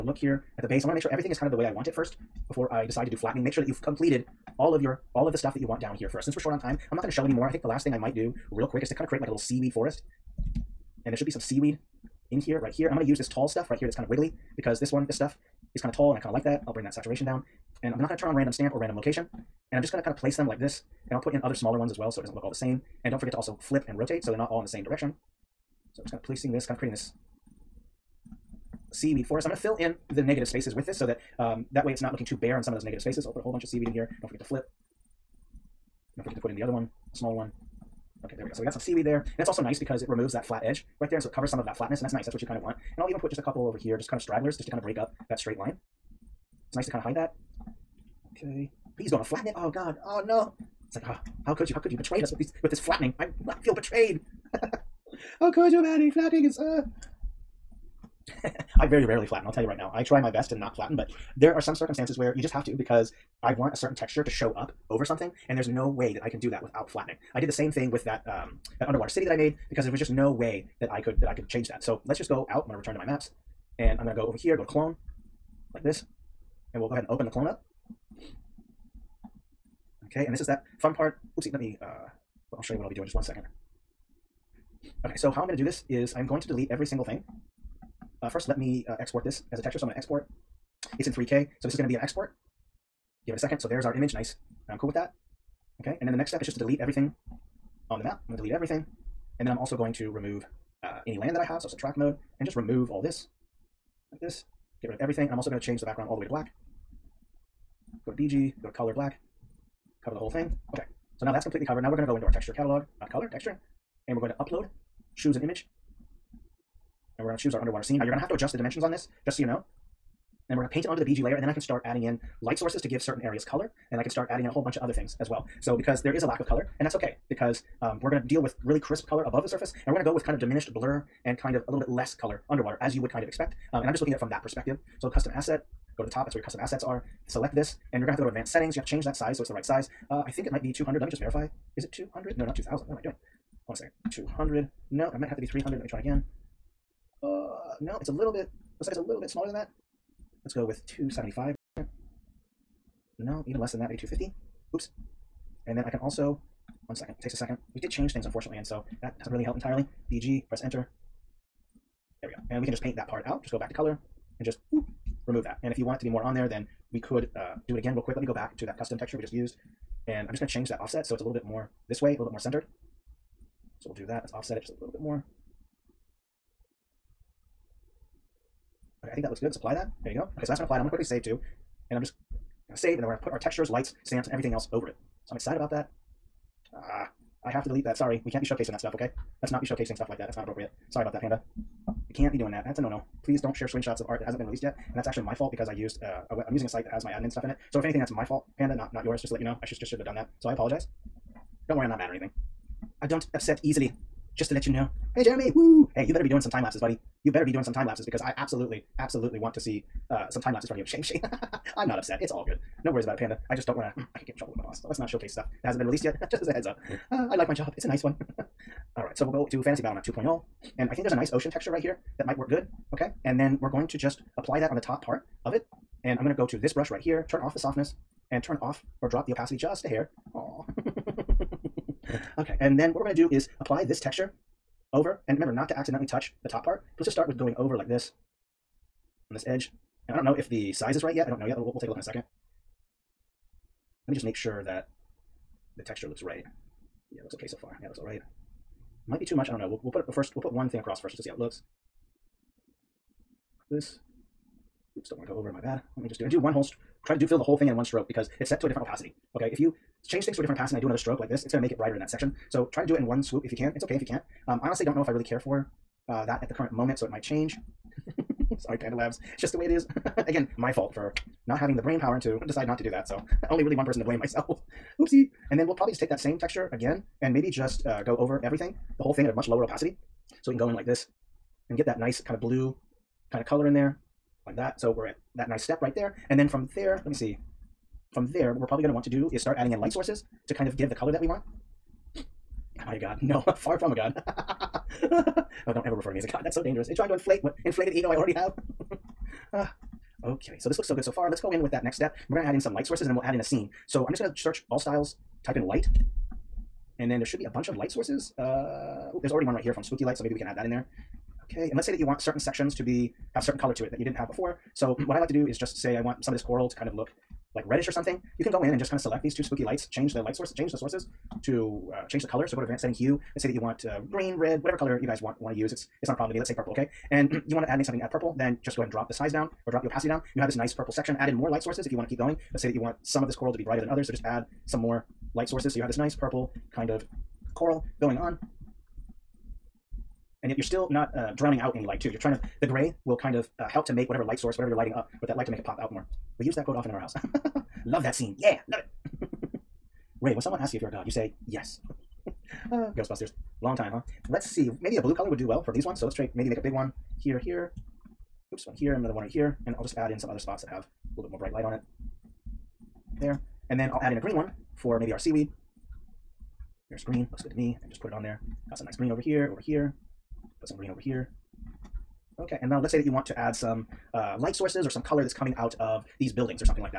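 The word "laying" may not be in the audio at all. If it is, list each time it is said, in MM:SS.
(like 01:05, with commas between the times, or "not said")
not said.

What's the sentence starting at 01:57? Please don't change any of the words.
Now you're going to have to adjust the dimensions on this, just so you know.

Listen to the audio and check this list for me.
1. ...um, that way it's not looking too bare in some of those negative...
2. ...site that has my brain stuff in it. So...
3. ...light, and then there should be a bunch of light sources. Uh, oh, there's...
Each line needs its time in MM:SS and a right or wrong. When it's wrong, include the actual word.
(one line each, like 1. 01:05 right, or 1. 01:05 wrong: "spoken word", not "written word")
1. 00:31 right
2. 03:16 wrong: "admin", not "brain"
3. 05:05 right.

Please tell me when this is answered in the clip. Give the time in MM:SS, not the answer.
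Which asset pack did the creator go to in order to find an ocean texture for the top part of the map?
03:39.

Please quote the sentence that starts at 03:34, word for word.
I could get in trouble with my boss.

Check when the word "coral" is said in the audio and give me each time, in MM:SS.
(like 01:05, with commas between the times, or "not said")
05:16, 05:33, 05:37.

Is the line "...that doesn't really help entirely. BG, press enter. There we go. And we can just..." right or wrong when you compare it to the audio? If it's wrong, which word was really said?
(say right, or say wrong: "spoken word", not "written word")
right.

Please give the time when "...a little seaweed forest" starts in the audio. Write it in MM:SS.
00:09.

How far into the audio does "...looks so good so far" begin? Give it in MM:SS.
05:00.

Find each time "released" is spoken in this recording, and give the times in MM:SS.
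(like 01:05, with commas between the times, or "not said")
03:14, 03:35.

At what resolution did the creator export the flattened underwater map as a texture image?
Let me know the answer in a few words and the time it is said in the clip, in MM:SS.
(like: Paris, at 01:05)
3K, at 01:31.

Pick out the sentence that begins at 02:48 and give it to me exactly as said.
Let me go back to that custom texture we just used.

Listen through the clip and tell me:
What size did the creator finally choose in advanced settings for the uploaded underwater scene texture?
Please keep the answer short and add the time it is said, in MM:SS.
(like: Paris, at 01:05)
250, at 02:33.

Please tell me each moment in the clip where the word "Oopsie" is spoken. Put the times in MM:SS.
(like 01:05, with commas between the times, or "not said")
01:21, 04:34.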